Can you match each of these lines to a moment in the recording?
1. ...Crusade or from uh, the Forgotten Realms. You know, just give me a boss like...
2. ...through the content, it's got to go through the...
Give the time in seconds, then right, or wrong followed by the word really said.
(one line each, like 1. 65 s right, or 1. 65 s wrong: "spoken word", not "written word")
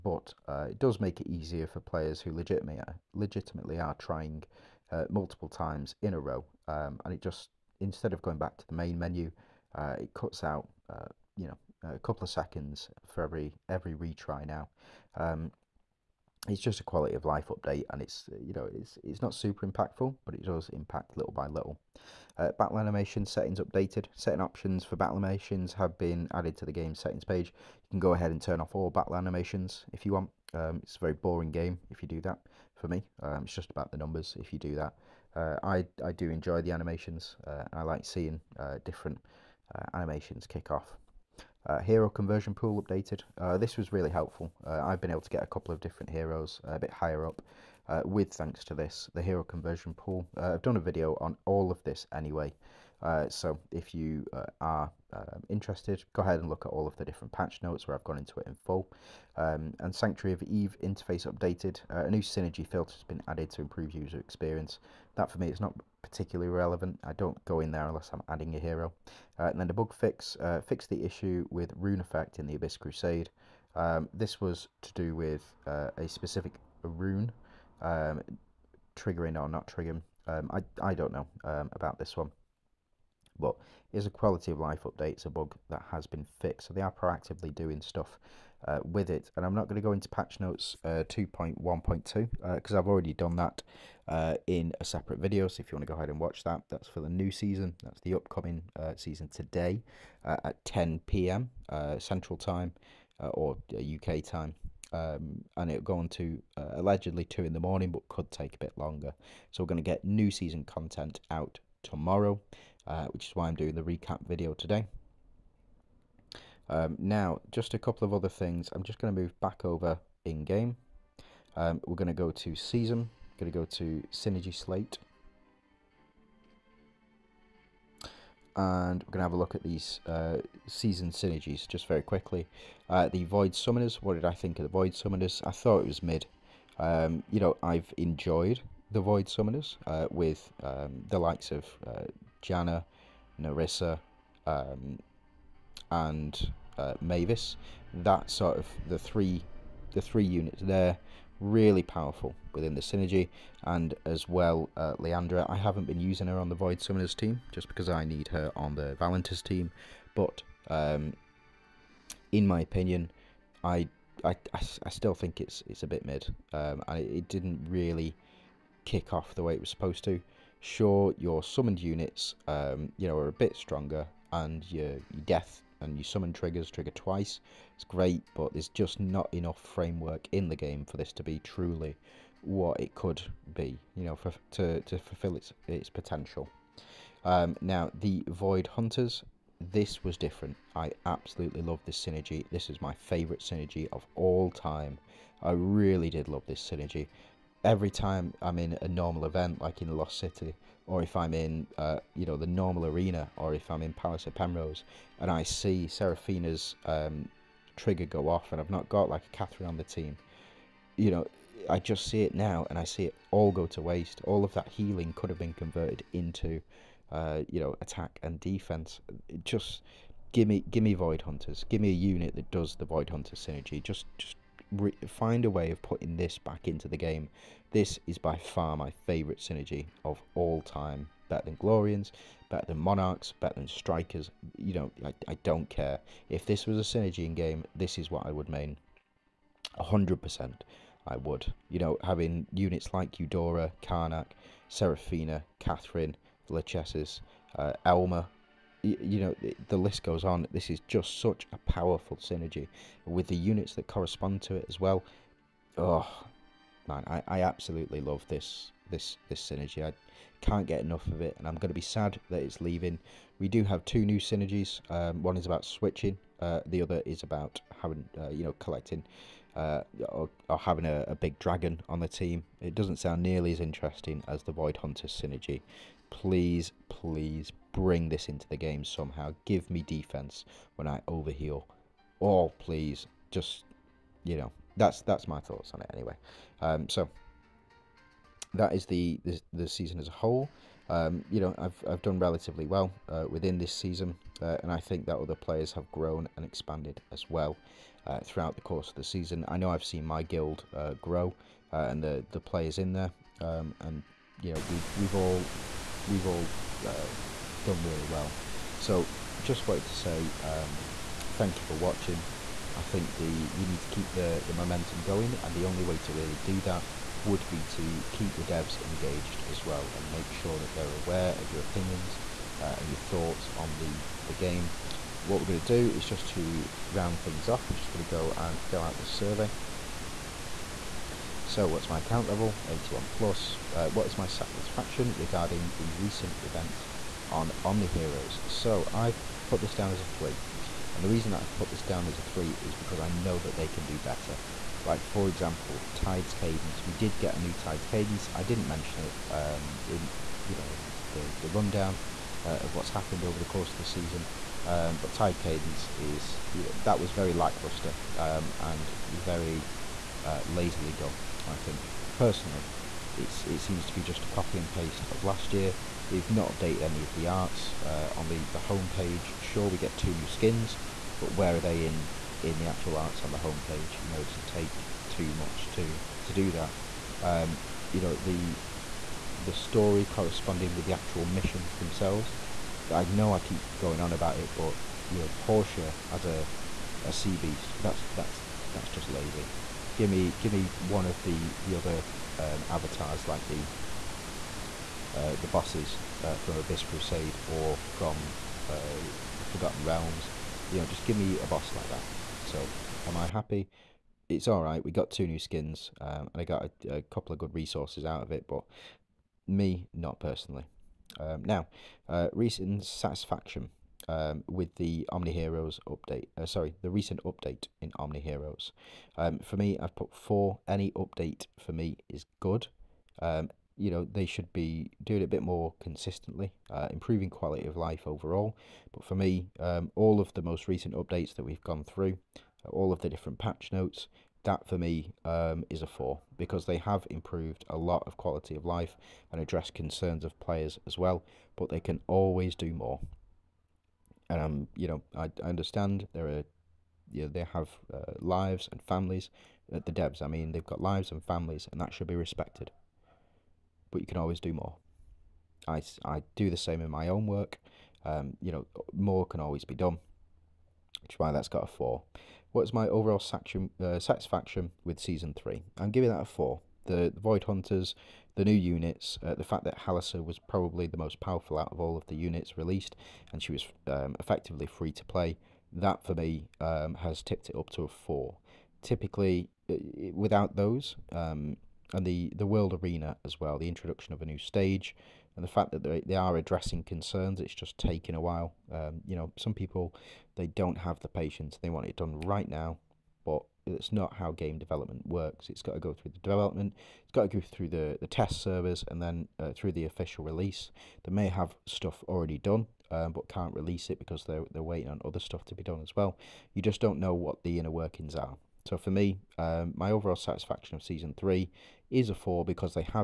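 1. 396 s right
2. 495 s wrong: "development", not "content".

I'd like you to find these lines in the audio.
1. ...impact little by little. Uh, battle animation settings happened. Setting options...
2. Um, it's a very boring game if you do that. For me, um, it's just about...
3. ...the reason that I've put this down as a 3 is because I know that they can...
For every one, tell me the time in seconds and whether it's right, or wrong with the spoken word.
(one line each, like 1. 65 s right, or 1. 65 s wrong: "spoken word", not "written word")
1. 20 s wrong: "updated", not "happened"
2. 30 s right
3. 341 s right.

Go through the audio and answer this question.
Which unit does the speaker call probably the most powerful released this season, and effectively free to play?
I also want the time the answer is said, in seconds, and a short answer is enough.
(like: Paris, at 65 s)
Halliser, at 469 s.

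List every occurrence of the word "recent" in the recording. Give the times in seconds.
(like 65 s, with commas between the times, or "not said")
335 s, 412 s, 416 s, 430 s.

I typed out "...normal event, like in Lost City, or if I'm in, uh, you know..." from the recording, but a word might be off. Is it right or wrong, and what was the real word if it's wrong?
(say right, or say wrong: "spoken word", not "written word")
right.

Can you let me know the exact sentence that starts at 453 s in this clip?
But you can always do more.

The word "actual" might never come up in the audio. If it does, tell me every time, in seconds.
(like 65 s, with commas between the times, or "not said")
372 s, 380 s.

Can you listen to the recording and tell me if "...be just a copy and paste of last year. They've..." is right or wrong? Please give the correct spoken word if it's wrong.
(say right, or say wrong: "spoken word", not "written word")
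right.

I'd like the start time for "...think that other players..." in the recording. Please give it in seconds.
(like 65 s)
294 s.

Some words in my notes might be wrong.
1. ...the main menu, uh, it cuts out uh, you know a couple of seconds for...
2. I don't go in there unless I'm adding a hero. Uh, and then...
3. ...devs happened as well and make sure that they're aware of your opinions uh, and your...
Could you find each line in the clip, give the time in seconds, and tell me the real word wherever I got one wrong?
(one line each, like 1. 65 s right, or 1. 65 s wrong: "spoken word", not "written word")
1. 8 s right
2. 67 s right
3. 318 s wrong: "engaged", not "happened".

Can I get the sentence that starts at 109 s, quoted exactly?
So we're going to get new season content out tomorrow, uh, which is why I'm doing the recap video today.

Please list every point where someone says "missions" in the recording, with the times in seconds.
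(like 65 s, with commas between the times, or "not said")
381 s.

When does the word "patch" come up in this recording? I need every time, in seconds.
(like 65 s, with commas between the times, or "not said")
57 s, 90 s, 433 s.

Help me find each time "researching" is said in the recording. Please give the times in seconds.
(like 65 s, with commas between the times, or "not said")
not said.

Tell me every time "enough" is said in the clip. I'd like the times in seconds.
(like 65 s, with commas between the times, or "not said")
179 s, 260 s.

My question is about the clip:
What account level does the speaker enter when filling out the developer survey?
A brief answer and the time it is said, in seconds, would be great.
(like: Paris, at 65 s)
81 plus, at 332 s.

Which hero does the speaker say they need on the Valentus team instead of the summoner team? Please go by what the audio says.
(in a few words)
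Leandra.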